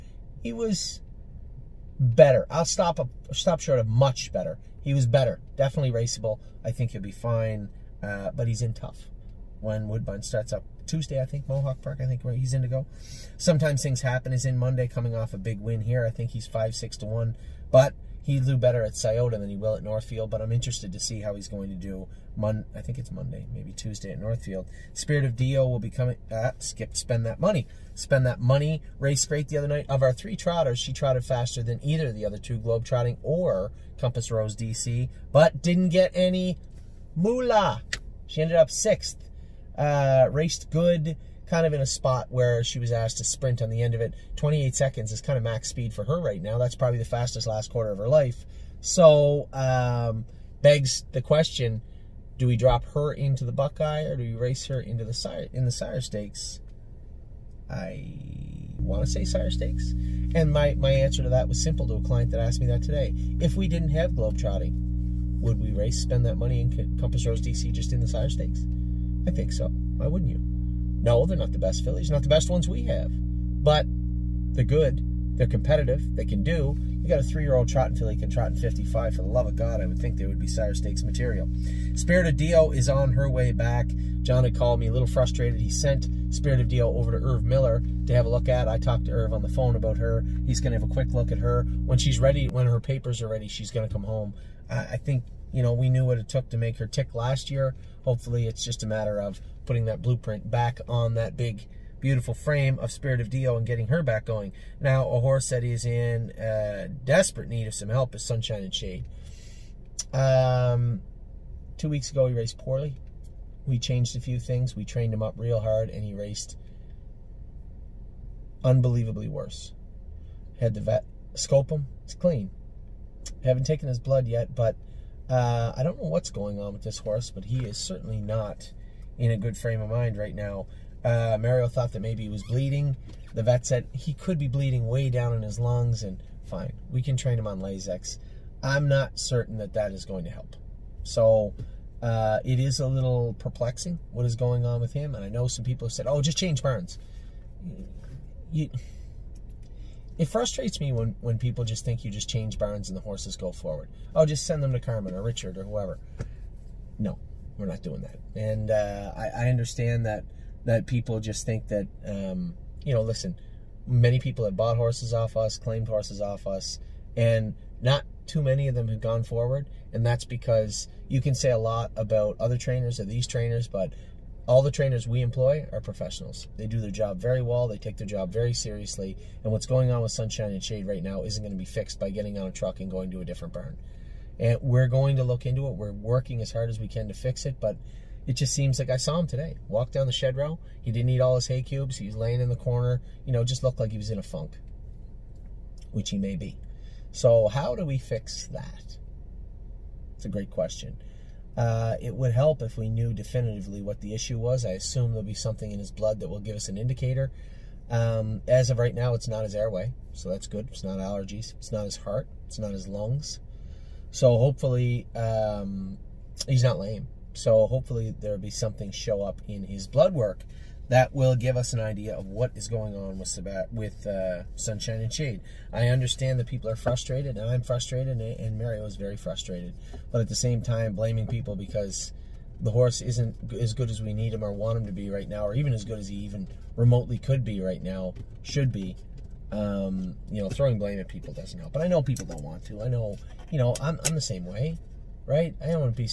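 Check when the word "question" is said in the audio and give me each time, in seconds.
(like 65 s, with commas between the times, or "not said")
51 s, 200 s.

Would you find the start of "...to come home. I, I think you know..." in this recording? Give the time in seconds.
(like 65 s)
93 s.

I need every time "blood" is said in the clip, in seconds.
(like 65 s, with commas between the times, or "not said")
123 s, 205 s, 219 s.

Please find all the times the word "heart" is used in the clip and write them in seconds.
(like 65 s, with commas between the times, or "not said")
211 s.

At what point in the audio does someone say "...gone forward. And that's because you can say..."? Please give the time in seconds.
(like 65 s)
169 s.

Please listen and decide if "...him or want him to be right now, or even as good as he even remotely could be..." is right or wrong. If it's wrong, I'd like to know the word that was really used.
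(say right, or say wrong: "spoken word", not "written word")
right.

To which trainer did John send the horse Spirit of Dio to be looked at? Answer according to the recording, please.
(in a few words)
Erv Miller.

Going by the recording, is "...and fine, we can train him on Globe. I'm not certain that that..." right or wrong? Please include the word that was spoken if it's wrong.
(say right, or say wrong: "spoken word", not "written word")
wrong: "Lasix", not "Globe".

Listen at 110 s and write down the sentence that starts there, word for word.
Um, two weeks ago, he raced poorly.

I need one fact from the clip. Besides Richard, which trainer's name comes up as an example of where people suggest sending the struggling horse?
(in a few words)
Carmen.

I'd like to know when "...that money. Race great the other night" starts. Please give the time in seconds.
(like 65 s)
28 s.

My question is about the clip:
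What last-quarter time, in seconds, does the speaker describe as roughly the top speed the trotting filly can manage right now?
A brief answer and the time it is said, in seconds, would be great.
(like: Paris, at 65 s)
28 seconds, at 44 s.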